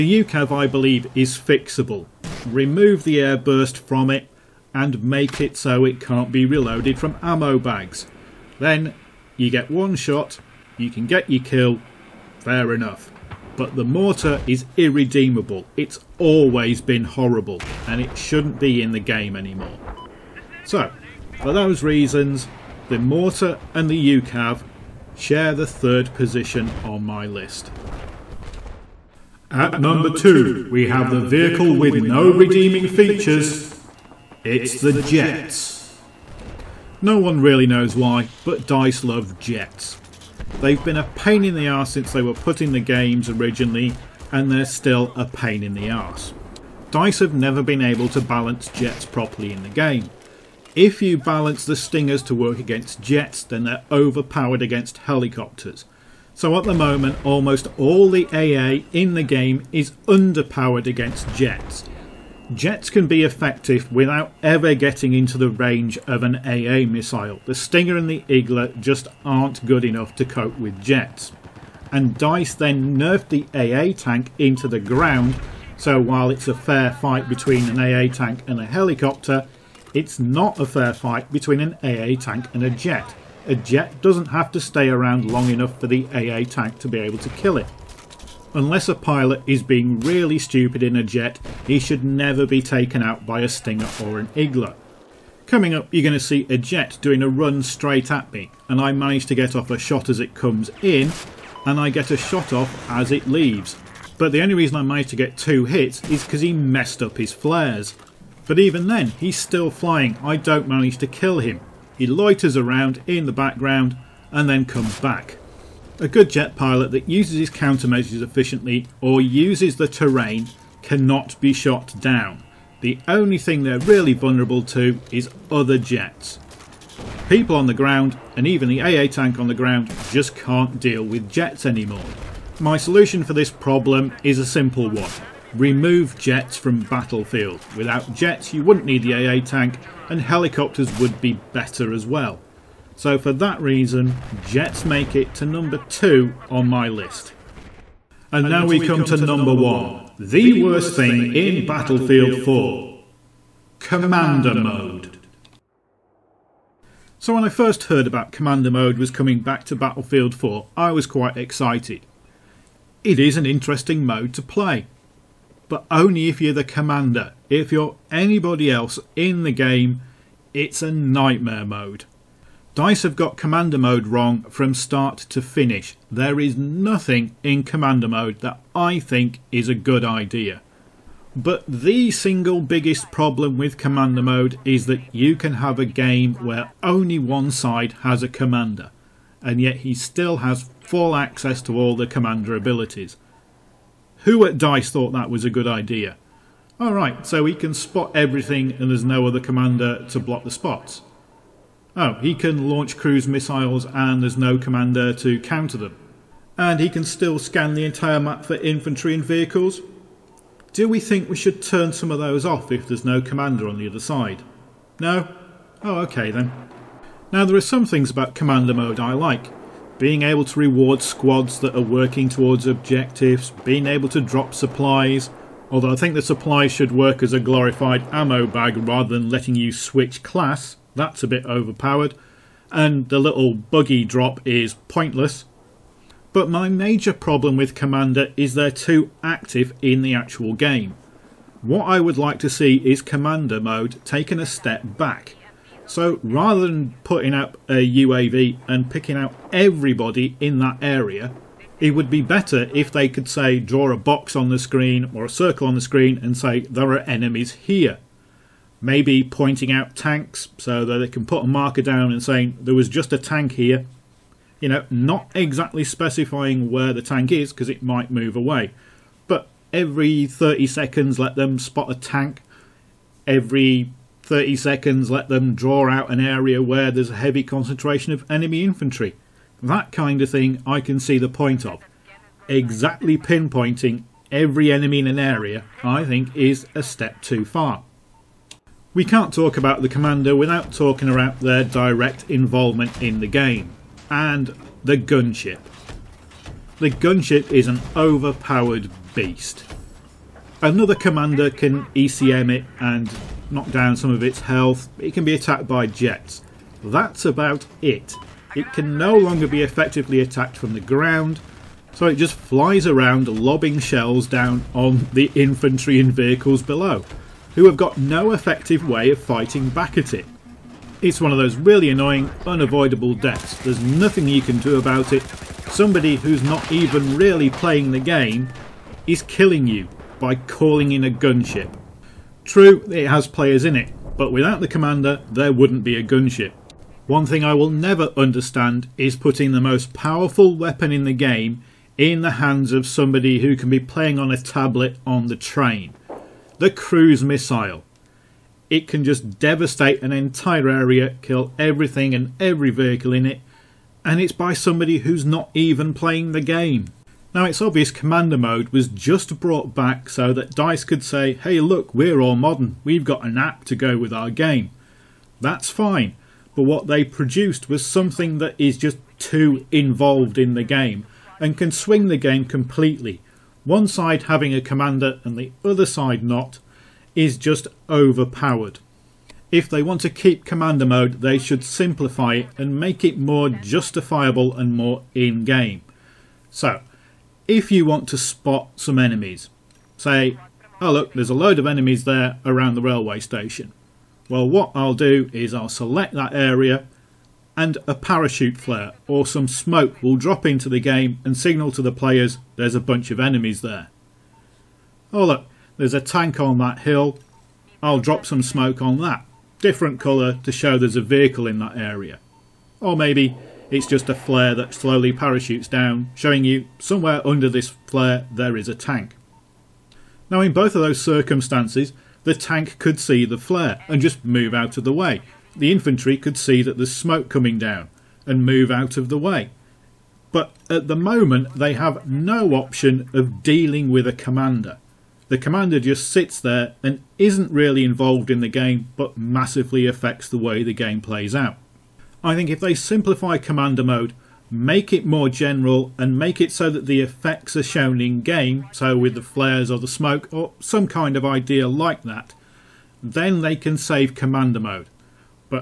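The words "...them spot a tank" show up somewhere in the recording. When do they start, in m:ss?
4:31.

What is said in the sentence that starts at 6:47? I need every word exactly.
I'll drop some smoke on that, different colour to show there's a vehicle in that area.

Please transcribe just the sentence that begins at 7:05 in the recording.
The infantry could see that there's smoke coming down and move out of the way.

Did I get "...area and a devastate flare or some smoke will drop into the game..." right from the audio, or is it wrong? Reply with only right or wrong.
wrong.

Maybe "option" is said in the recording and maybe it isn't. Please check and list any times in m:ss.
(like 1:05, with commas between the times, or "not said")
7:12.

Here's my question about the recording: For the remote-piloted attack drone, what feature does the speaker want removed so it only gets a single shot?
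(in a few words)
air burst.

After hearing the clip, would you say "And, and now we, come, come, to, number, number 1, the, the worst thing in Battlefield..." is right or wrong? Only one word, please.
right.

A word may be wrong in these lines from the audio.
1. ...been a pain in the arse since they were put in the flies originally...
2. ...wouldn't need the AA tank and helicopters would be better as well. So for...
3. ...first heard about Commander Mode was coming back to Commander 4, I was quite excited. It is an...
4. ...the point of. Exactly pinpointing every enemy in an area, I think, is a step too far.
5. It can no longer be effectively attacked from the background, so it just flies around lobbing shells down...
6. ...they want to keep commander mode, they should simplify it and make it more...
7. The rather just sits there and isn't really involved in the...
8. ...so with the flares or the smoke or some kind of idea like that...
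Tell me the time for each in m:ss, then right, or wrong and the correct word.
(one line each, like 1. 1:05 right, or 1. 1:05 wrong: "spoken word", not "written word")
1. 0:40 wrong: "games", not "flies"
2. 2:18 right
3. 2:37 wrong: "Battlefield", not "Commander"
4. 4:41 right
5. 5:08 wrong: "ground", not "background"
6. 6:19 right
7. 7:15 wrong: "commander", not "rather"
8. 7:28 right.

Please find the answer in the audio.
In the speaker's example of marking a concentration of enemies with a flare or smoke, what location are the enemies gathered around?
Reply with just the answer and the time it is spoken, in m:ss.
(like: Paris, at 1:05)
the railway station, at 6:32.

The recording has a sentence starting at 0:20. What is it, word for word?
So, for those reasons, the mortar and the UCAV share the third position on my list.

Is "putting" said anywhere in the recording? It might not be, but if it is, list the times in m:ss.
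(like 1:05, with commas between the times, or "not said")
4:07, 5:39.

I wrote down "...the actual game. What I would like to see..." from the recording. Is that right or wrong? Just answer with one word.
right.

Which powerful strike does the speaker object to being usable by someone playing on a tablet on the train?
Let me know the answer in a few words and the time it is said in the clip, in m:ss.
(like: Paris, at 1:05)
cruise missile, at 5:46.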